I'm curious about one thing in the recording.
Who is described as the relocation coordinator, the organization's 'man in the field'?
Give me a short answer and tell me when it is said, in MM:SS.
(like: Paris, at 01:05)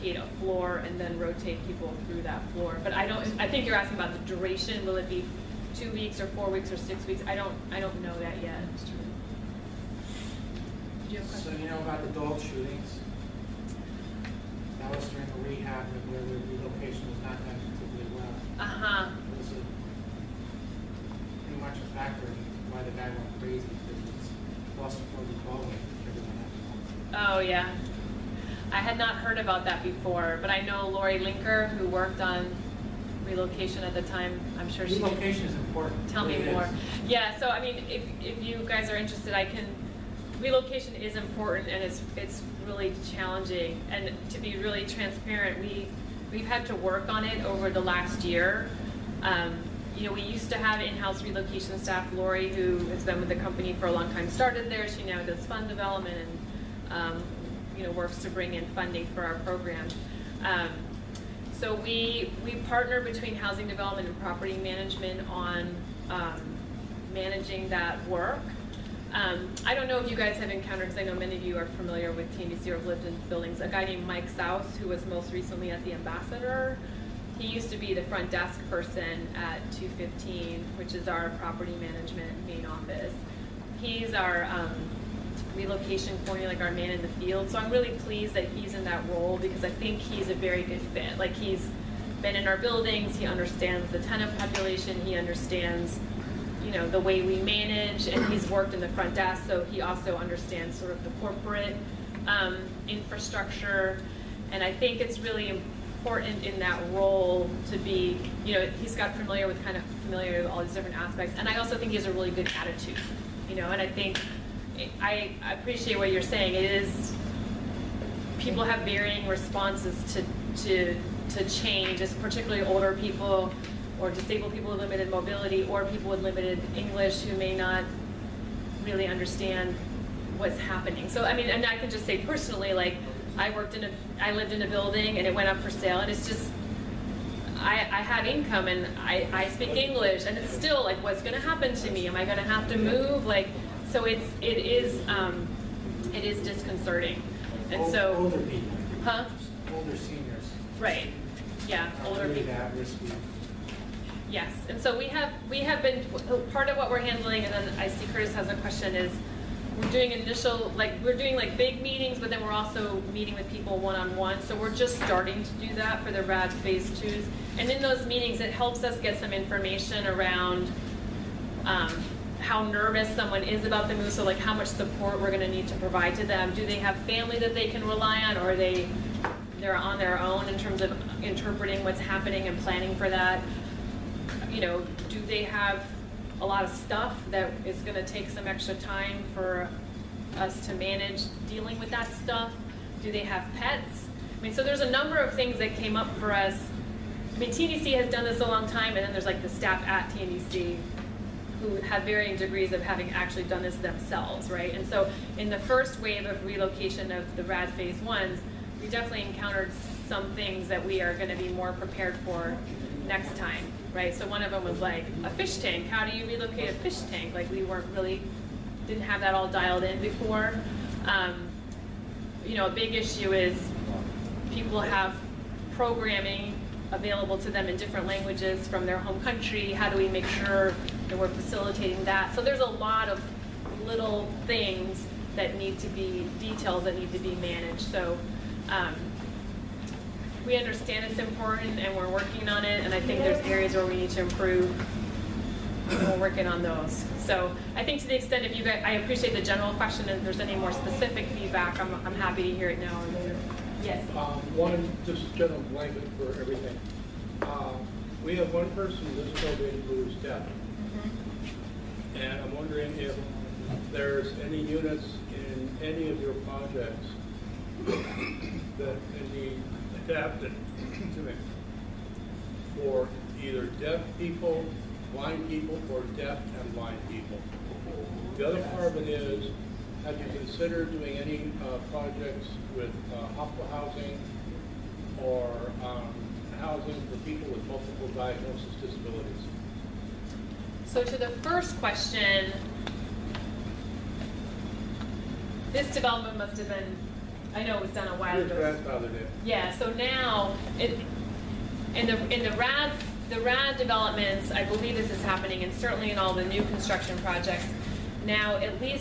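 Mike Souse, at 01:14.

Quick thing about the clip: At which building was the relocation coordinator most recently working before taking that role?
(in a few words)
the Ambassador.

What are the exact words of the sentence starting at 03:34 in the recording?
So one of them was like, a fish tank, how do you relocate a fish tank?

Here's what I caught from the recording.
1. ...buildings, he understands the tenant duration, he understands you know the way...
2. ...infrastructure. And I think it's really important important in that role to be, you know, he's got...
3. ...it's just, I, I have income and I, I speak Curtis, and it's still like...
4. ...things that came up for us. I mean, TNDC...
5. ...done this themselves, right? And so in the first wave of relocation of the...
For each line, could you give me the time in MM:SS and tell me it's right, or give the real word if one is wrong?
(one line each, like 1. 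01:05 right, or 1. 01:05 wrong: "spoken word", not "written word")
1. 01:32 wrong: "population", not "duration"
2. 01:42 right
3. 02:16 wrong: "English", not "Curtis"
4. 03:15 right
5. 03:23 right.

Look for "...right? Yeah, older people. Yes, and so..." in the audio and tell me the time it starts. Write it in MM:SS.
02:30.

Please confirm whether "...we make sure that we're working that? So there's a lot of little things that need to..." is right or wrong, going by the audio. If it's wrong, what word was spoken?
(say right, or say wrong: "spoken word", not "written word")
wrong: "facilitating", not "working".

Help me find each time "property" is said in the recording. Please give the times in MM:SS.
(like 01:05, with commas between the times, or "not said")
01:04, 01:21.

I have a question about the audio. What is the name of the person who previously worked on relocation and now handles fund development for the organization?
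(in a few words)
Lori Linker.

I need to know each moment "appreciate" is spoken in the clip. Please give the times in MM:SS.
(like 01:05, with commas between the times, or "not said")
01:55, 04:08.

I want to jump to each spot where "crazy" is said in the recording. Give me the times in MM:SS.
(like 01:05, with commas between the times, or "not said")
00:23.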